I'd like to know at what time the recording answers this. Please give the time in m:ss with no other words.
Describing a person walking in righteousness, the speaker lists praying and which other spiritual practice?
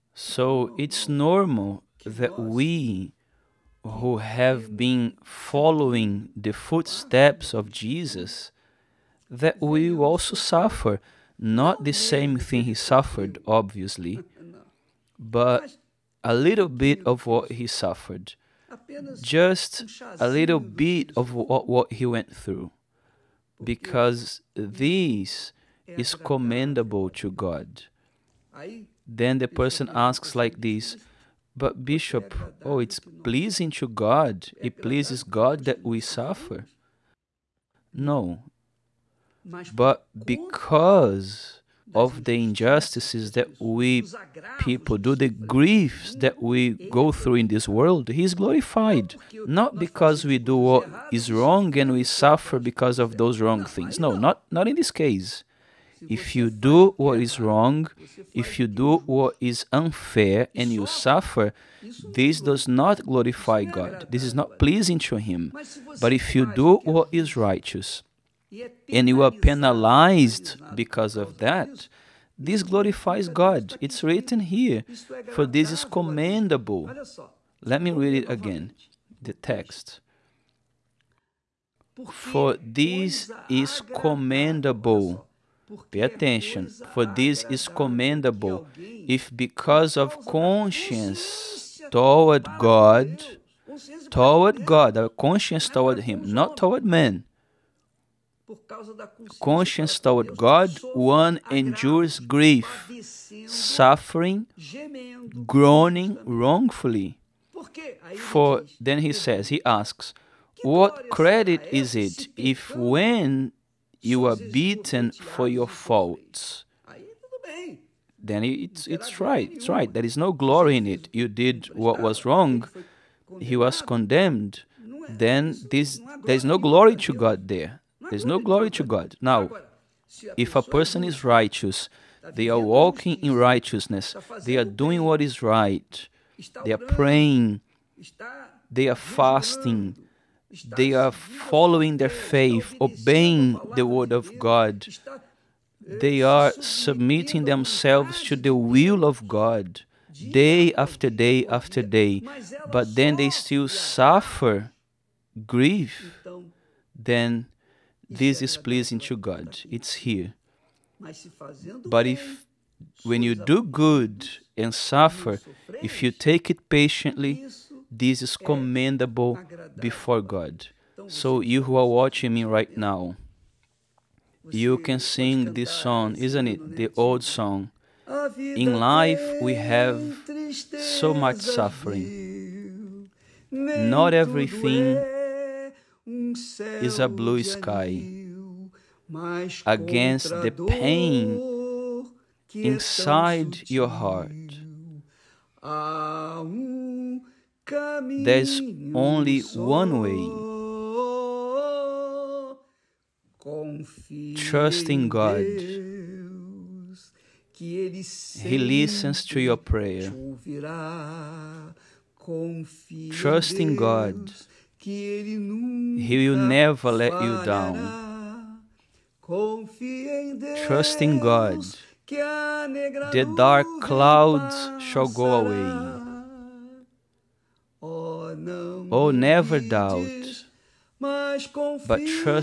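2:18.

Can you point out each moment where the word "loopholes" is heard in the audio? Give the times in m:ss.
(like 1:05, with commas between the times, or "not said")
not said.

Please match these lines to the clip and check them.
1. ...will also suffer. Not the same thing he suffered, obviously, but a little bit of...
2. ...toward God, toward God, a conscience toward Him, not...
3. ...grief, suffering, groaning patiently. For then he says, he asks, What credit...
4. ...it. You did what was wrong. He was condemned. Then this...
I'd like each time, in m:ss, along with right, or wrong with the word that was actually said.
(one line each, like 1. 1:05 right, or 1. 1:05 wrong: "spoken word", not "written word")
1. 0:09 right
2. 1:31 right
3. 1:42 wrong: "wrongfully", not "patiently"
4. 2:00 right.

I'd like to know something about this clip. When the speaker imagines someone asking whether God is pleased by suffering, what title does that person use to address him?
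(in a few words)
Bishop.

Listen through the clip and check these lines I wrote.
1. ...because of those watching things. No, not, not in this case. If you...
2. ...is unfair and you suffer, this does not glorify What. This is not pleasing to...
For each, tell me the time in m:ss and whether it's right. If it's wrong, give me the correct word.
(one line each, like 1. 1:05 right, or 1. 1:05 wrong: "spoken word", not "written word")
1. 0:52 wrong: "wrong", not "watching"
2. 0:59 wrong: "God", not "What".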